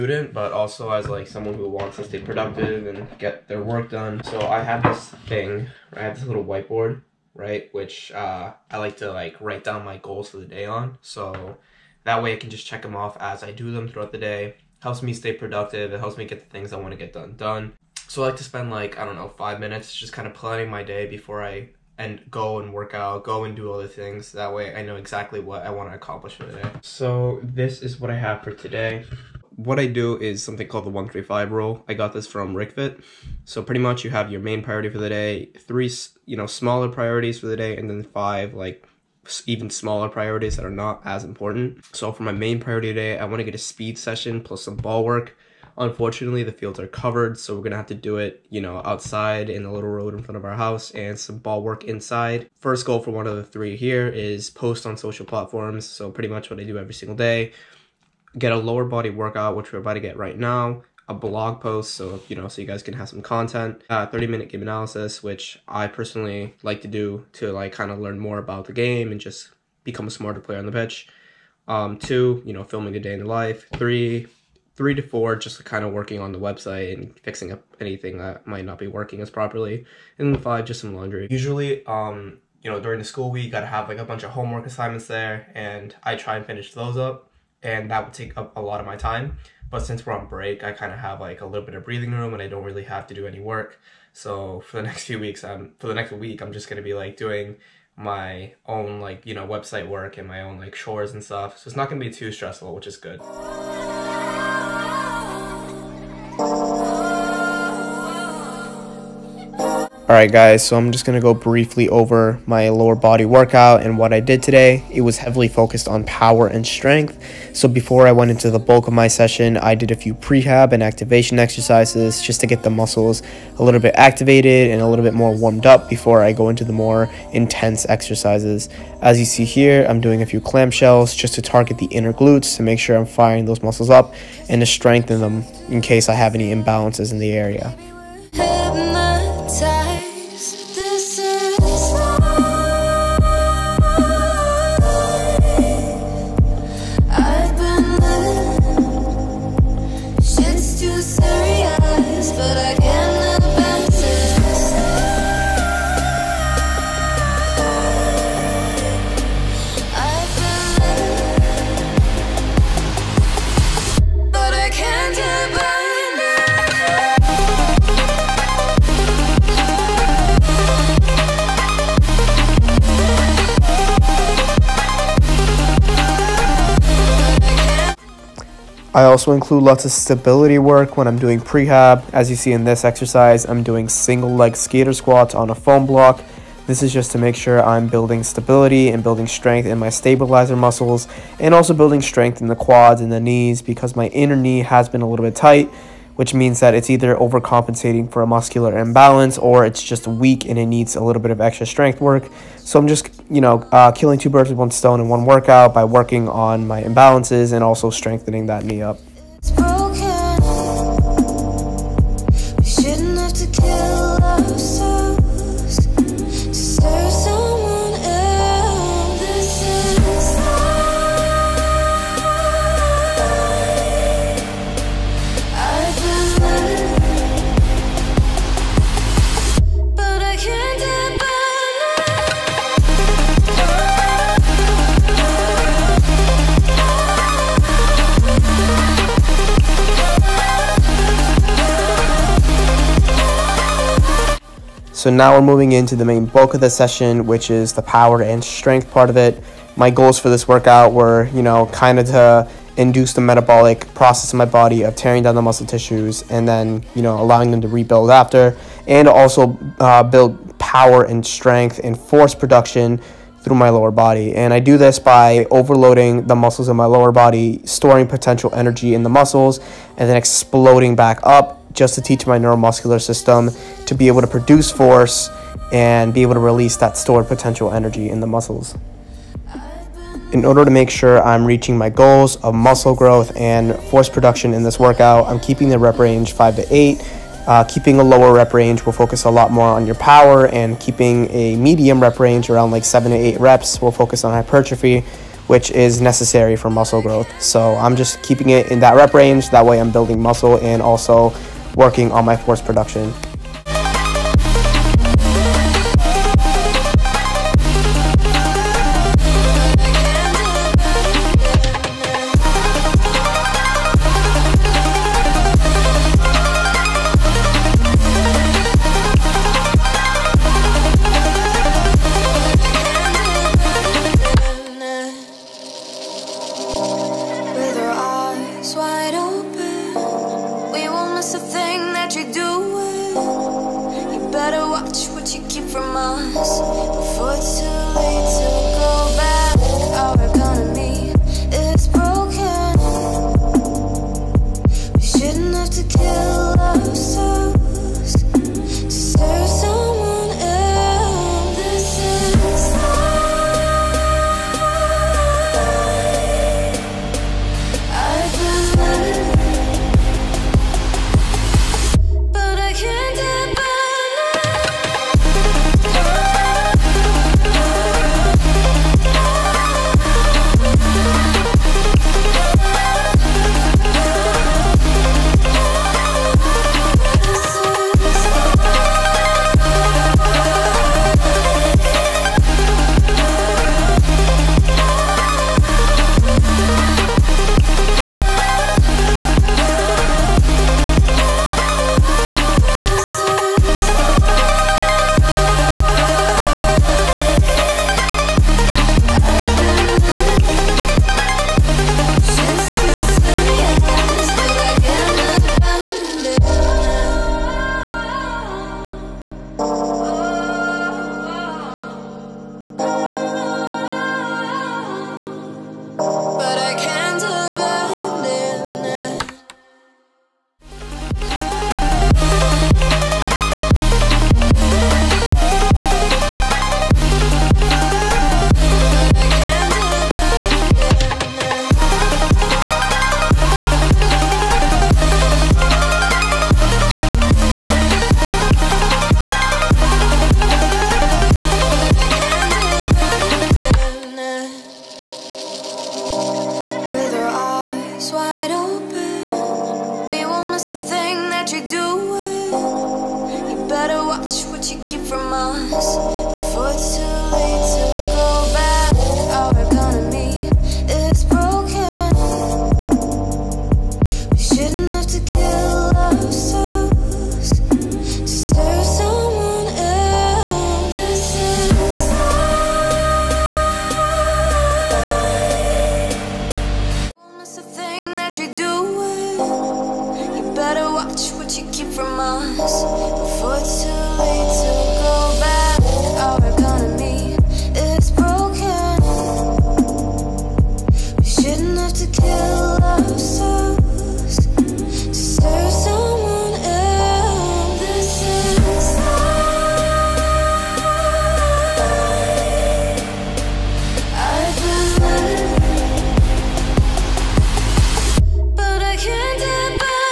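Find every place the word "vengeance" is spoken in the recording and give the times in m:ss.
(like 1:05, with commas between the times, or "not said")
not said.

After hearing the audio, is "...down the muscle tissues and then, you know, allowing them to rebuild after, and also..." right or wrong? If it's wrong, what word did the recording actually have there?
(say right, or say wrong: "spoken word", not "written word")
right.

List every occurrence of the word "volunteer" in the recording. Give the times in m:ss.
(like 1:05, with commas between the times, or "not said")
not said.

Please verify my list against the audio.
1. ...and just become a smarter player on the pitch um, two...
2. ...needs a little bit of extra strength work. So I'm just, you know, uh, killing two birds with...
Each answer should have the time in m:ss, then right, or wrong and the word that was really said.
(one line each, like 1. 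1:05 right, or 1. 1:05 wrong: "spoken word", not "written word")
1. 1:09 right
2. 3:20 right.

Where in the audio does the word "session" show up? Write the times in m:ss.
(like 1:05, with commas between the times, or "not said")
0:43, 1:59, 4:06.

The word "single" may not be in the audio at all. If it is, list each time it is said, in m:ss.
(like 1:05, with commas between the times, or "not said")
0:56, 3:03.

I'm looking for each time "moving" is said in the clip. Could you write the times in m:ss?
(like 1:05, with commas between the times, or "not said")
4:05.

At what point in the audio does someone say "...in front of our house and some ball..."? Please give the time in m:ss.
0:50.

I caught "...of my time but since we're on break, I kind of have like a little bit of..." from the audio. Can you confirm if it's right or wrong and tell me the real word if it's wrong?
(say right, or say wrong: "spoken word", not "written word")
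right.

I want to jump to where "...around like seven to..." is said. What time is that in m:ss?
4:52.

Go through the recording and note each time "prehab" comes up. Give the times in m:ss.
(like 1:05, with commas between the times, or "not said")
2:00, 3:01.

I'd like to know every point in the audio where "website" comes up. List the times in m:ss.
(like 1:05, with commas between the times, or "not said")
1:16, 1:39.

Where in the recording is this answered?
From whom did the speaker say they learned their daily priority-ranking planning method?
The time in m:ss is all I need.
0:32.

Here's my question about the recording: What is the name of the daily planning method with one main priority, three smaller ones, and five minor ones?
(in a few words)
135 rule.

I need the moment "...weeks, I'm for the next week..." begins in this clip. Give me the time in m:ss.
1:35.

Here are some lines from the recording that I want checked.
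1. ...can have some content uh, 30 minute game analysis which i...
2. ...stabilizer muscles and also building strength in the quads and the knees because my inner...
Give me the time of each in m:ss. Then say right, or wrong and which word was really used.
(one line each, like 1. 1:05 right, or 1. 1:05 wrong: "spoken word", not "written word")
1. 1:02 right
2. 3:09 right.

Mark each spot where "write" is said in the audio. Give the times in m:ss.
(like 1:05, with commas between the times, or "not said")
0:09.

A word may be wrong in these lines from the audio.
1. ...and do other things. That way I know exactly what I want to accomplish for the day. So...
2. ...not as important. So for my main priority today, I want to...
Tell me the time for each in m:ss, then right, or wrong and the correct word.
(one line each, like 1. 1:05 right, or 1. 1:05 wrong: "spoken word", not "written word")
1. 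0:23 right
2. 0:40 right.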